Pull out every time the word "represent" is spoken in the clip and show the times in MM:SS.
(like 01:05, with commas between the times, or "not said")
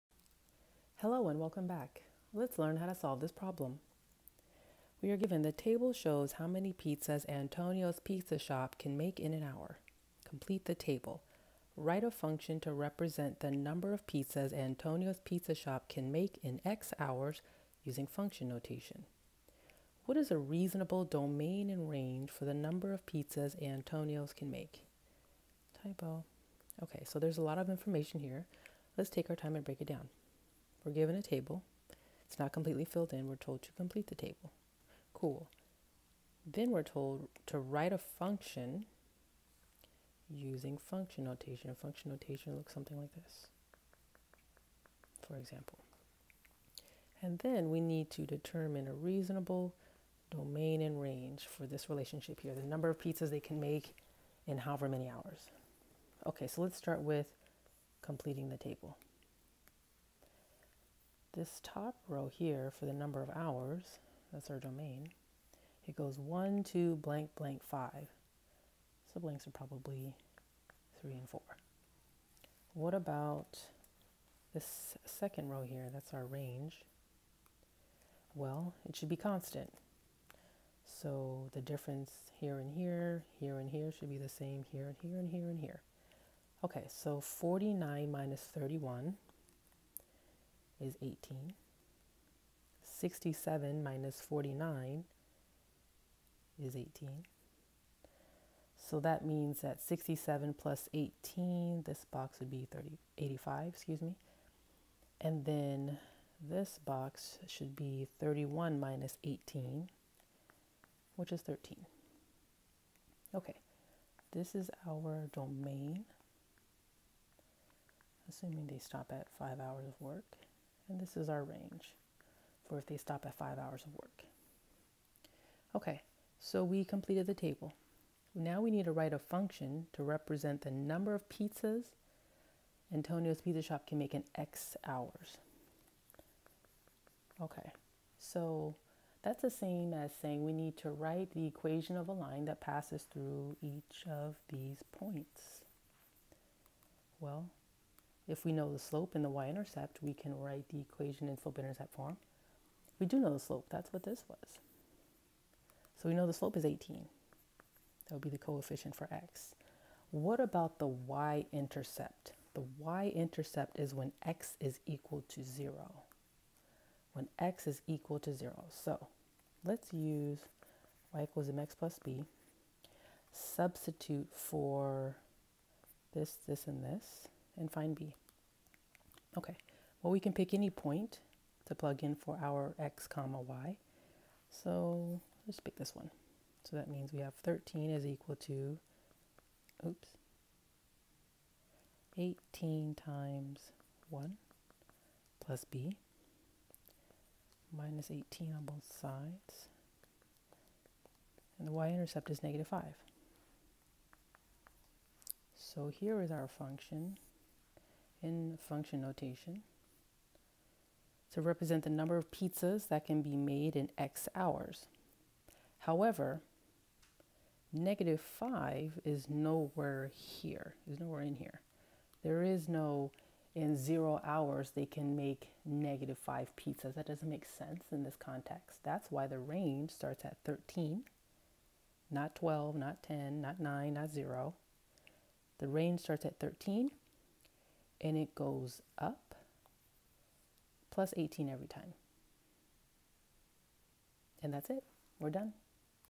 00:12, 02:10, 03:31.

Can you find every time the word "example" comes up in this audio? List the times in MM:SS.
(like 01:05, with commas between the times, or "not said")
00:45.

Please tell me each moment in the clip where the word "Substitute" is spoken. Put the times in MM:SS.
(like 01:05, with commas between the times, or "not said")
02:53.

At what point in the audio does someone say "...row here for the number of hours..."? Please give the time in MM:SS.
01:02.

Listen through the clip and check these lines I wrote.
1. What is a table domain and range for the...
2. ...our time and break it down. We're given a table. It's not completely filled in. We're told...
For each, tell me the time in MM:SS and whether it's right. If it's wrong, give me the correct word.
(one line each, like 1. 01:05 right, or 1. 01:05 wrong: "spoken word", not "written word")
1. 00:20 wrong: "reasonable", not "table"
2. 00:29 right.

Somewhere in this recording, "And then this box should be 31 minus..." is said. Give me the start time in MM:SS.
01:45.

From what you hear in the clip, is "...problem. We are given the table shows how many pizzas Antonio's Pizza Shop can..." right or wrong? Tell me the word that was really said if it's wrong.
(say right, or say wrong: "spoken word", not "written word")
right.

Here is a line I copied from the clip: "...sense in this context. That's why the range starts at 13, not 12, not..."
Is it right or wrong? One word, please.
right.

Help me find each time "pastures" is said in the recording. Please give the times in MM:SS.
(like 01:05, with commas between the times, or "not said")
not said.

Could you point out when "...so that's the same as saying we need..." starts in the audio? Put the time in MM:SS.
02:18.